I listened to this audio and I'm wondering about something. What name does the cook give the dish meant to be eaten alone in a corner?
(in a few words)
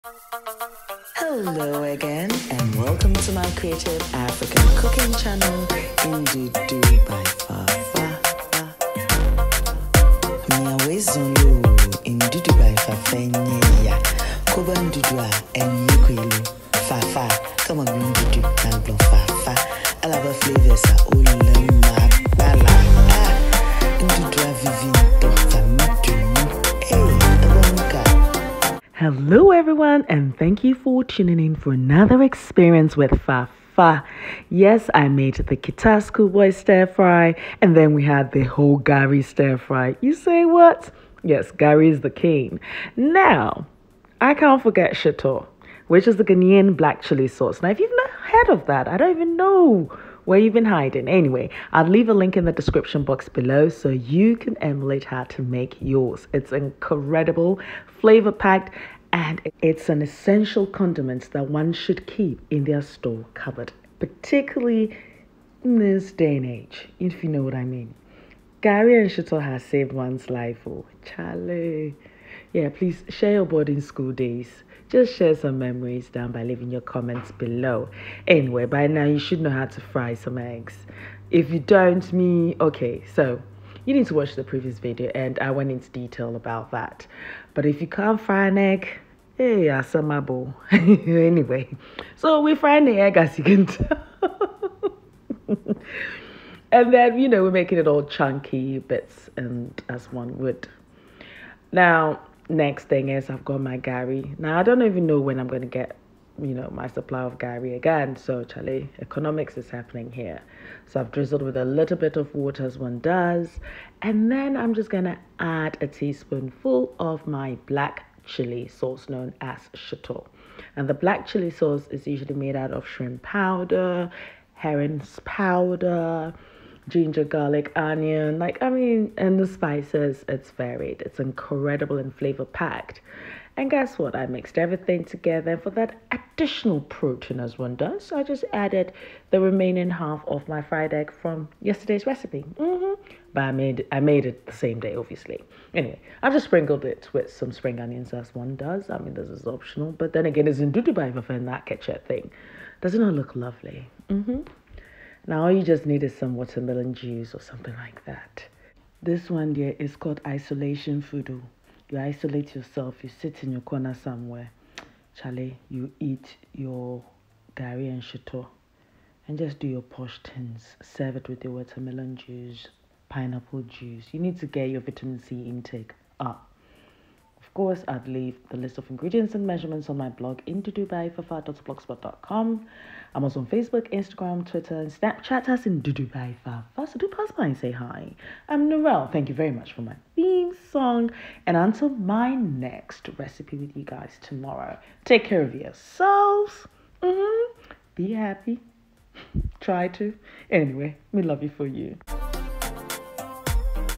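isolation fudu.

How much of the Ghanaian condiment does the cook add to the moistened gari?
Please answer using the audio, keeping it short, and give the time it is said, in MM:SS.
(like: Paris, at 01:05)
a teaspoonful, at 01:55.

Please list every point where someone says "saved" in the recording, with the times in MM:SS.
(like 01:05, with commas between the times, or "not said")
01:09.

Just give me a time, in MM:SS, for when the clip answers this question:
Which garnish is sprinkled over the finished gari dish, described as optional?
02:27.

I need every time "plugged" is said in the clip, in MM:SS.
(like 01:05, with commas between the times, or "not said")
not said.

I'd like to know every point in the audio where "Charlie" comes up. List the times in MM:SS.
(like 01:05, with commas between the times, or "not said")
01:11, 01:48, 02:45.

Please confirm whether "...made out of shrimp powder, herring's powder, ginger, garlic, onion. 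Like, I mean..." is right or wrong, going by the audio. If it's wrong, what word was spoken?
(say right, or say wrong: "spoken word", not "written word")
right.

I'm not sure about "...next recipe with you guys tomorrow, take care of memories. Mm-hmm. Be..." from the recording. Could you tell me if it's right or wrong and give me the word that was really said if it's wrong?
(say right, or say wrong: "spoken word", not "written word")
wrong: "yourselves", not "memories".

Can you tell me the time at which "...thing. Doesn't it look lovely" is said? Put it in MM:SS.
02:32.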